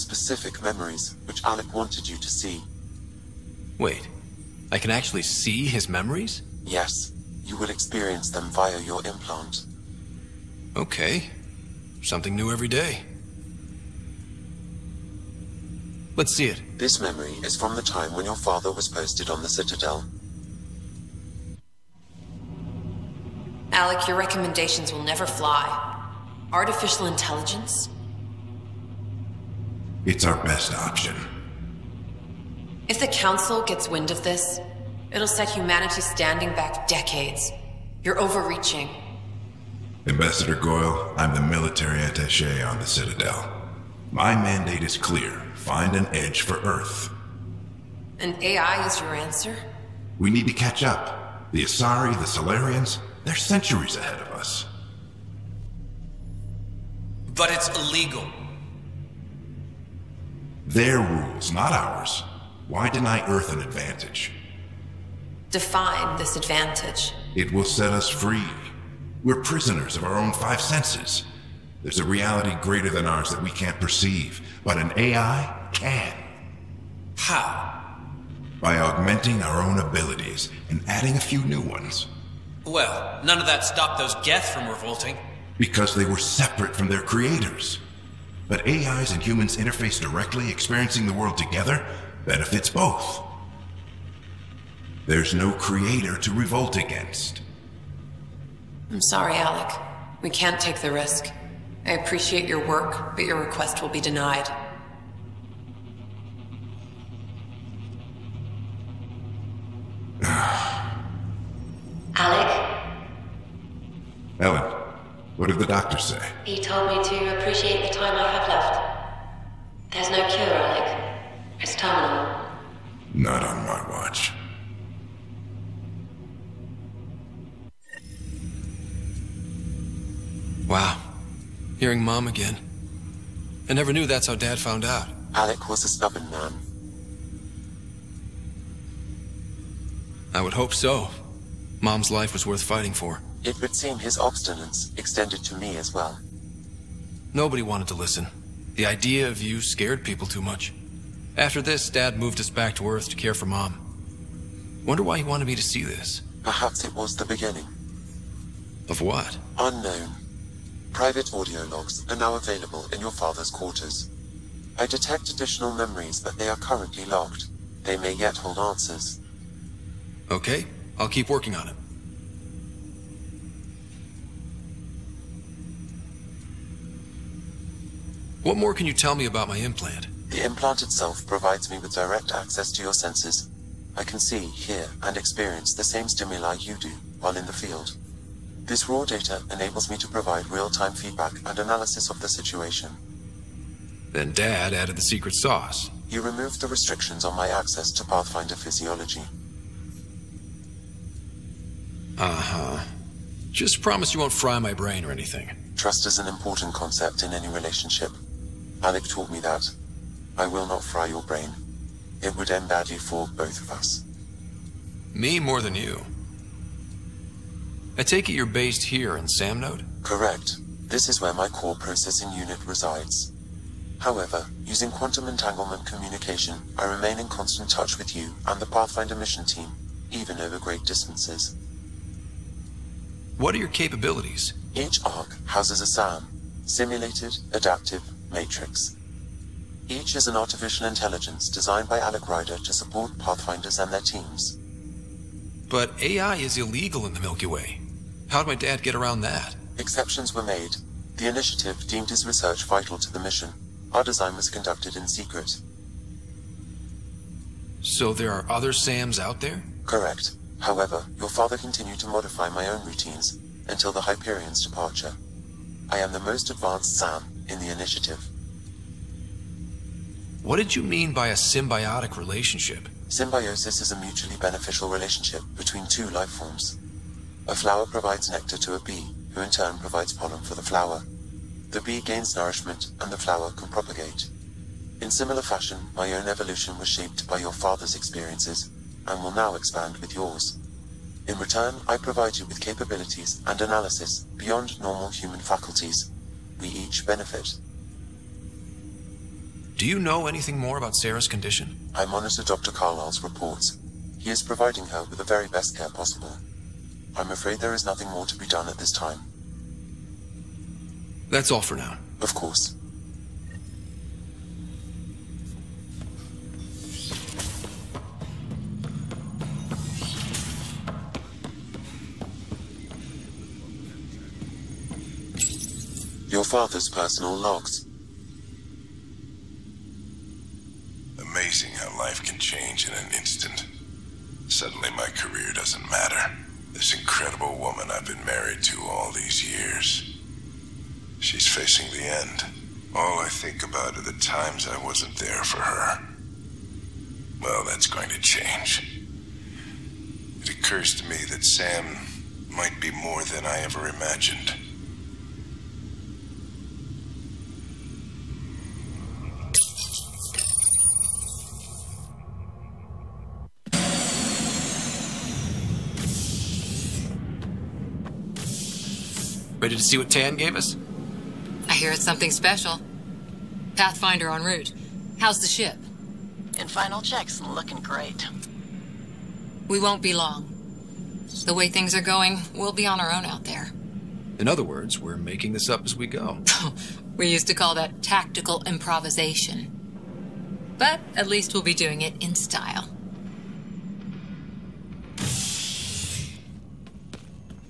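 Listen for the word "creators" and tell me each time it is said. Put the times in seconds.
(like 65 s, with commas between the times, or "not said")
87 s, 95 s.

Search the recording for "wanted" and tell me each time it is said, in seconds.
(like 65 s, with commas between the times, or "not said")
1 s, 147 s, 155 s.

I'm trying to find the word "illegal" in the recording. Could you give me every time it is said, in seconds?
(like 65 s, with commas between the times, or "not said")
57 s, 246 s.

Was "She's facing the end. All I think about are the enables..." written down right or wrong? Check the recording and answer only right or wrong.
wrong.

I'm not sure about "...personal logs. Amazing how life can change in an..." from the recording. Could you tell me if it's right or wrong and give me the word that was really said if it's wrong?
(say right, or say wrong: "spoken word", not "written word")
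right.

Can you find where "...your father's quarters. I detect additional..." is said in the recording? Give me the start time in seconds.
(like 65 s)
163 s.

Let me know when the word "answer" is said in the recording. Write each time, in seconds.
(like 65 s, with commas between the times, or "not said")
49 s, 168 s.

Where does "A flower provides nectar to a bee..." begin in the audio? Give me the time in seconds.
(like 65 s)
277 s.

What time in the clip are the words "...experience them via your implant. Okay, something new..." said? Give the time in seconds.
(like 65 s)
7 s.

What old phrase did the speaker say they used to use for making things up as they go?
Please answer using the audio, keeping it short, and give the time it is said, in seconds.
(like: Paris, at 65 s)
tactical improvisation, at 388 s.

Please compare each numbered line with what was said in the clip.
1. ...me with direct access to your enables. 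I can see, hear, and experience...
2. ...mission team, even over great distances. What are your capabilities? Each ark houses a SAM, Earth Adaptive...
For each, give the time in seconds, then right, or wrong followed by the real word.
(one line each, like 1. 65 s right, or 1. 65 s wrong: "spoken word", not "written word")
1. 181 s wrong: "senses", not "enables"
2. 229 s wrong: "Simulated", not "Earth".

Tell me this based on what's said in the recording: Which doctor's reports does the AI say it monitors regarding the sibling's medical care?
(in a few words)
Dr. Carlyle.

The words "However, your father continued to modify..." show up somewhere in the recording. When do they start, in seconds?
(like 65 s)
260 s.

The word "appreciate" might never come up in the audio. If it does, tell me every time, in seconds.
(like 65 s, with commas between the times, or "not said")
101 s, 117 s.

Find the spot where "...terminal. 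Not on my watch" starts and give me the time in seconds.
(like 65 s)
121 s.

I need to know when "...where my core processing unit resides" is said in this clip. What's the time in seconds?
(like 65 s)
221 s.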